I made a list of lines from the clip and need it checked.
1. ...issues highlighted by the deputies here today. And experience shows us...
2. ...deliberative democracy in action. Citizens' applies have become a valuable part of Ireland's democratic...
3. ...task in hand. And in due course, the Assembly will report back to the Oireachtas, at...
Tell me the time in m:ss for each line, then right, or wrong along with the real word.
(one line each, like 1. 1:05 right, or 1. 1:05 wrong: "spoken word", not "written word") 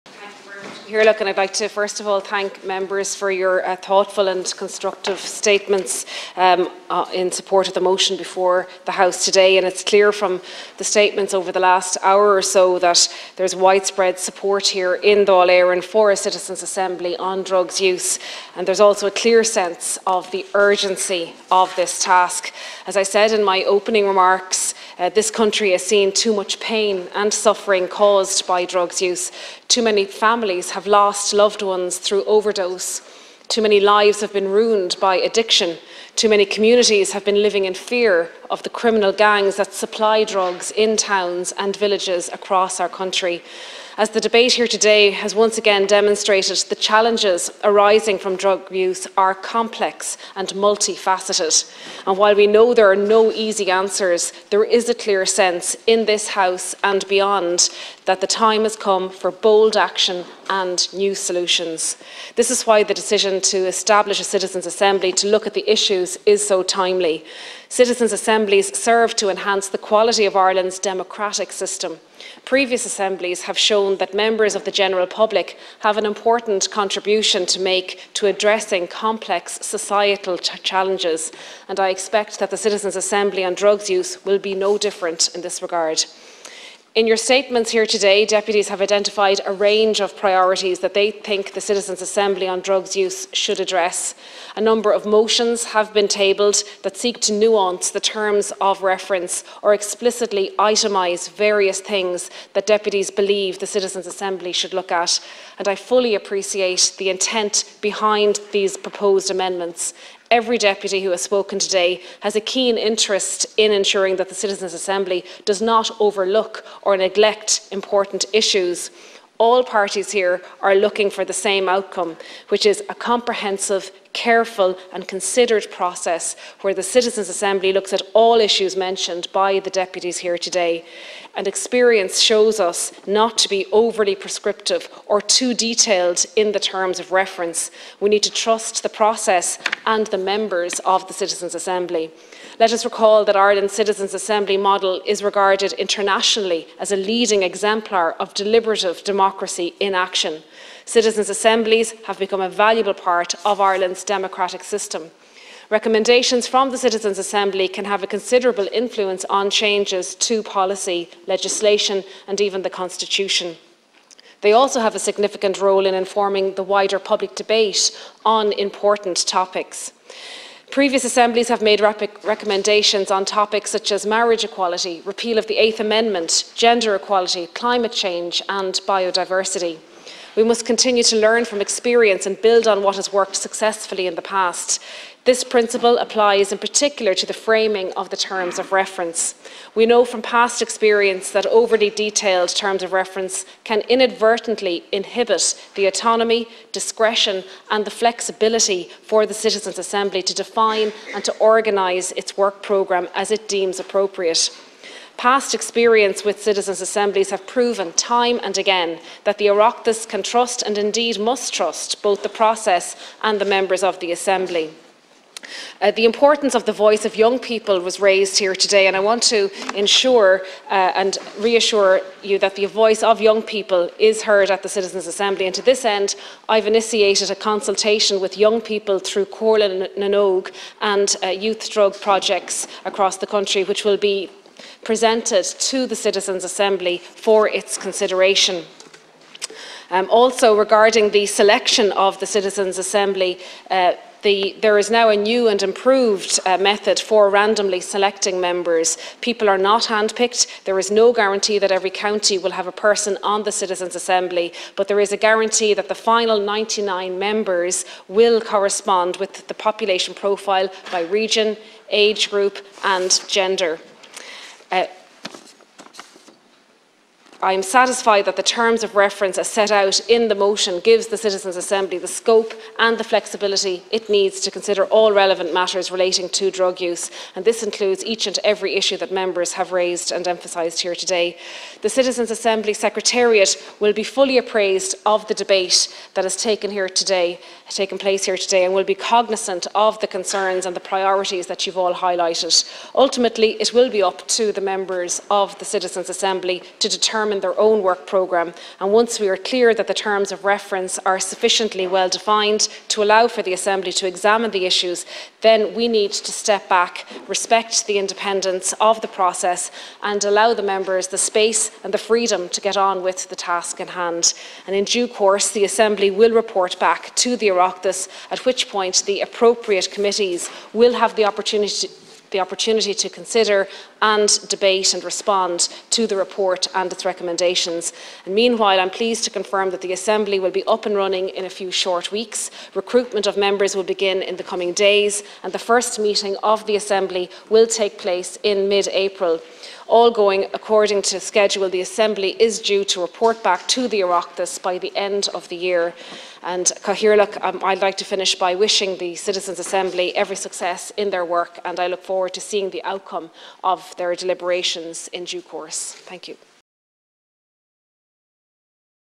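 1. 2:08 wrong: "mentioned", not "highlighted"
2. 2:28 wrong: "assemblies", not "applies"
3. 5:13 right.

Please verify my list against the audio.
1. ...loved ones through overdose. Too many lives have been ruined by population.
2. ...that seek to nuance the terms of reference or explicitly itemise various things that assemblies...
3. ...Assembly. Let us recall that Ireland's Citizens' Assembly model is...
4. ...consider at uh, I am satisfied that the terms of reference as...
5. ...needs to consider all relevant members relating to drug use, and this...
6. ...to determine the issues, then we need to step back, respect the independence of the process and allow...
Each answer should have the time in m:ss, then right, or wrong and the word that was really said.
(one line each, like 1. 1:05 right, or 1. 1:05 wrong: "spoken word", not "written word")
1. 0:31 wrong: "addiction", not "population"
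2. 1:36 wrong: "deputies", not "assemblies"
3. 2:21 right
4. 4:23 wrong: "gender", not "consider"
5. 4:34 wrong: "matters", not "members"
6. 5:03 wrong: "examine", not "determine".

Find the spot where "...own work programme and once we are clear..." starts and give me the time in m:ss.
4:57.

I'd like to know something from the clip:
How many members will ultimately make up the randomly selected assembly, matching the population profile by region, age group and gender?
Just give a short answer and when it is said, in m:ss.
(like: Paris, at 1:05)
99, at 4:16.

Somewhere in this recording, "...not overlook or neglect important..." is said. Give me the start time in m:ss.
1:55.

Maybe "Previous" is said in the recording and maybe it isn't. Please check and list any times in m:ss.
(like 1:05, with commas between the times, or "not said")
1:12, 2:50.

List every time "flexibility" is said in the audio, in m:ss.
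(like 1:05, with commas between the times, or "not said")
3:17, 4:33.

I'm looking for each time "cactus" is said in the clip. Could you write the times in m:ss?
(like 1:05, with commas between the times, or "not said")
not said.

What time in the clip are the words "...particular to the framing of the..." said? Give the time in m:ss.
3:06.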